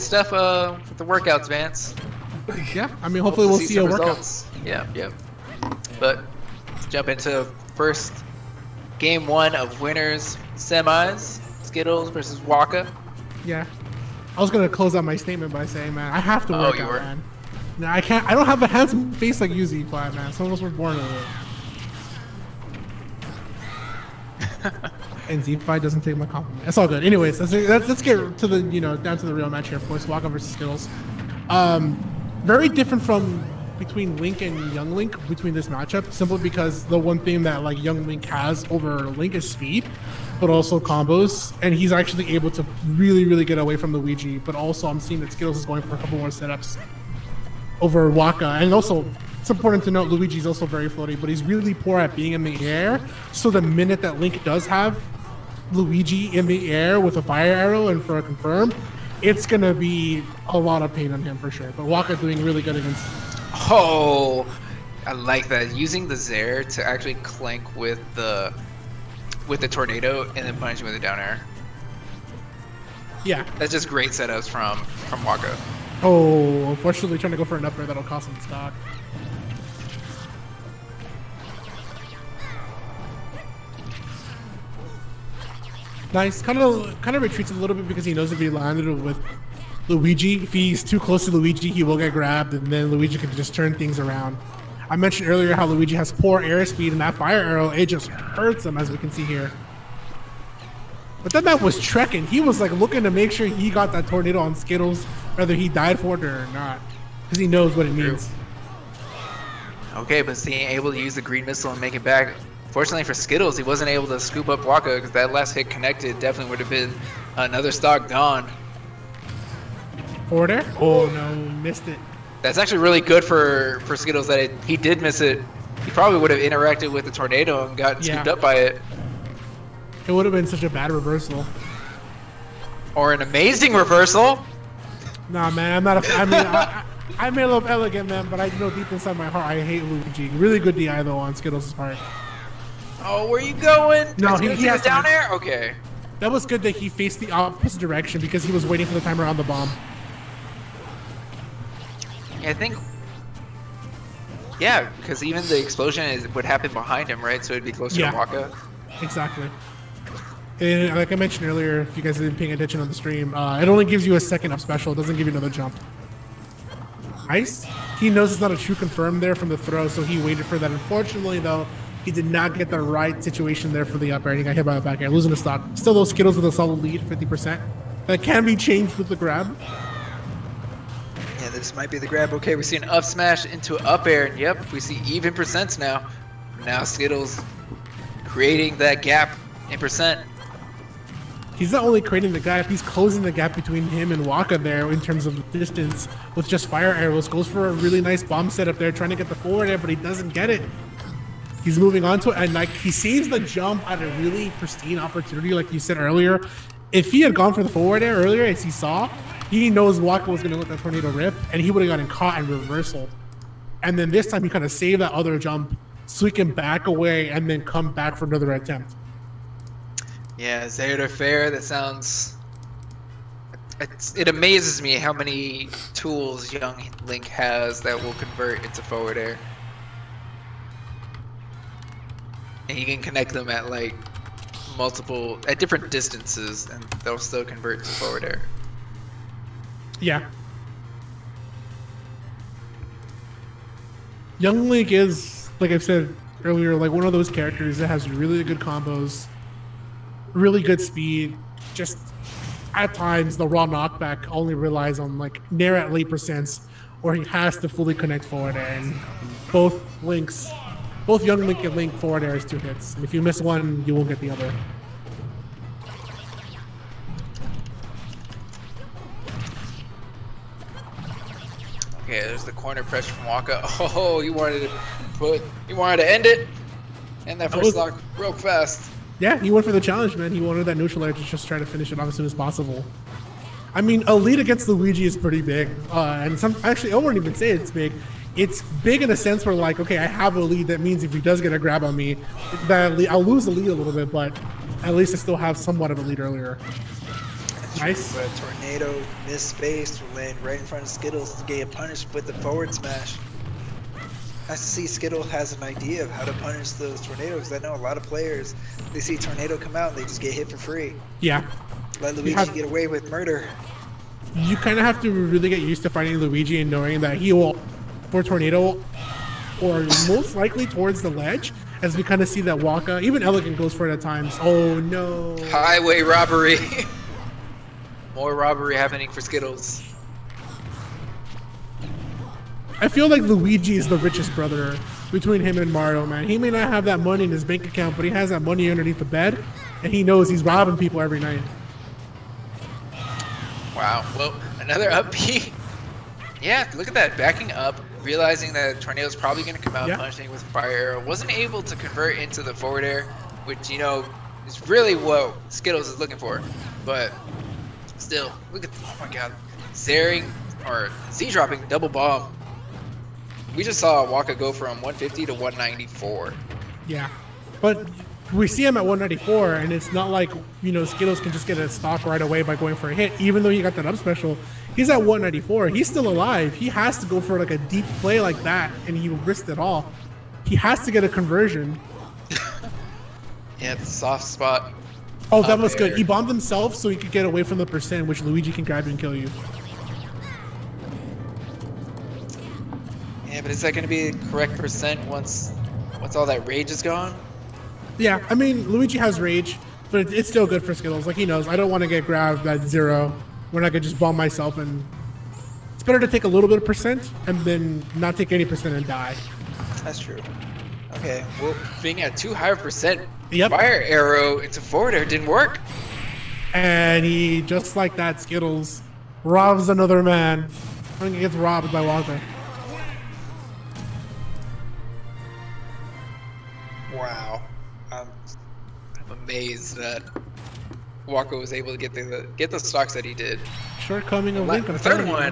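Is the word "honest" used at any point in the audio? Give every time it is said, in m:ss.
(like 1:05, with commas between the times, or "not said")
not said.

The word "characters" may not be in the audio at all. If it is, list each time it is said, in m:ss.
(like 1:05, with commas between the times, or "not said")
4:07.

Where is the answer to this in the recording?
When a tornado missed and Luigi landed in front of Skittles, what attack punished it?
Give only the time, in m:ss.
5:02.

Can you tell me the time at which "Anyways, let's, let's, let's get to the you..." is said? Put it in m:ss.
0:27.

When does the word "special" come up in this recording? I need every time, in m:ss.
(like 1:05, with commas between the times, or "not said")
2:44, 6:13.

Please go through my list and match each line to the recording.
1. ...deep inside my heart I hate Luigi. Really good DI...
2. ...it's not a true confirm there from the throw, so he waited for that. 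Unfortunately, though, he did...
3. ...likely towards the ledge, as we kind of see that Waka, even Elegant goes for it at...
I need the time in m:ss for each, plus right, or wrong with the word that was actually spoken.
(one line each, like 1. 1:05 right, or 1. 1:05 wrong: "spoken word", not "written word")
1. 2:18 right
2. 2:48 right
3. 5:20 right.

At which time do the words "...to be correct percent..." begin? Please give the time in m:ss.
6:33.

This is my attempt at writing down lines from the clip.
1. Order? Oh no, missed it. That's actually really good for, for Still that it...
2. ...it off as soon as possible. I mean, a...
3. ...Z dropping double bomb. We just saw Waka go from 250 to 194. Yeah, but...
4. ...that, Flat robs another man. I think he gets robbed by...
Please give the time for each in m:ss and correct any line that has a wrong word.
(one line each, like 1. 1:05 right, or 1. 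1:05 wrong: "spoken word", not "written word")
1. 2:00 wrong: "Skittles", not "Still"
2. 4:41 right
3. 6:01 wrong: "150", not "250"
4. 6:57 wrong: "Skittles", not "Flat".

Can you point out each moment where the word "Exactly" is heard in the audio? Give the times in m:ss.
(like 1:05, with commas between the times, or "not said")
2:39.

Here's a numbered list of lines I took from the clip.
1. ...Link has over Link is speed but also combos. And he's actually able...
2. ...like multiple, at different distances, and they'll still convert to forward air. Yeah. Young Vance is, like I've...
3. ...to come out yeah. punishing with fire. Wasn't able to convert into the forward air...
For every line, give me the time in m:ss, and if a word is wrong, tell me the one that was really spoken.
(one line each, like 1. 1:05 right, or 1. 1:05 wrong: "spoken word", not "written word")
1. 0:38 right
2. 3:53 wrong: "Link", not "Vance"
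3. 5:49 right.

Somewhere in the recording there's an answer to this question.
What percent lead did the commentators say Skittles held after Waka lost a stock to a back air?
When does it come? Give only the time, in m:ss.
2:57.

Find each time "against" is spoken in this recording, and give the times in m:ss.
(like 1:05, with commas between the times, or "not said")
1:02, 4:44.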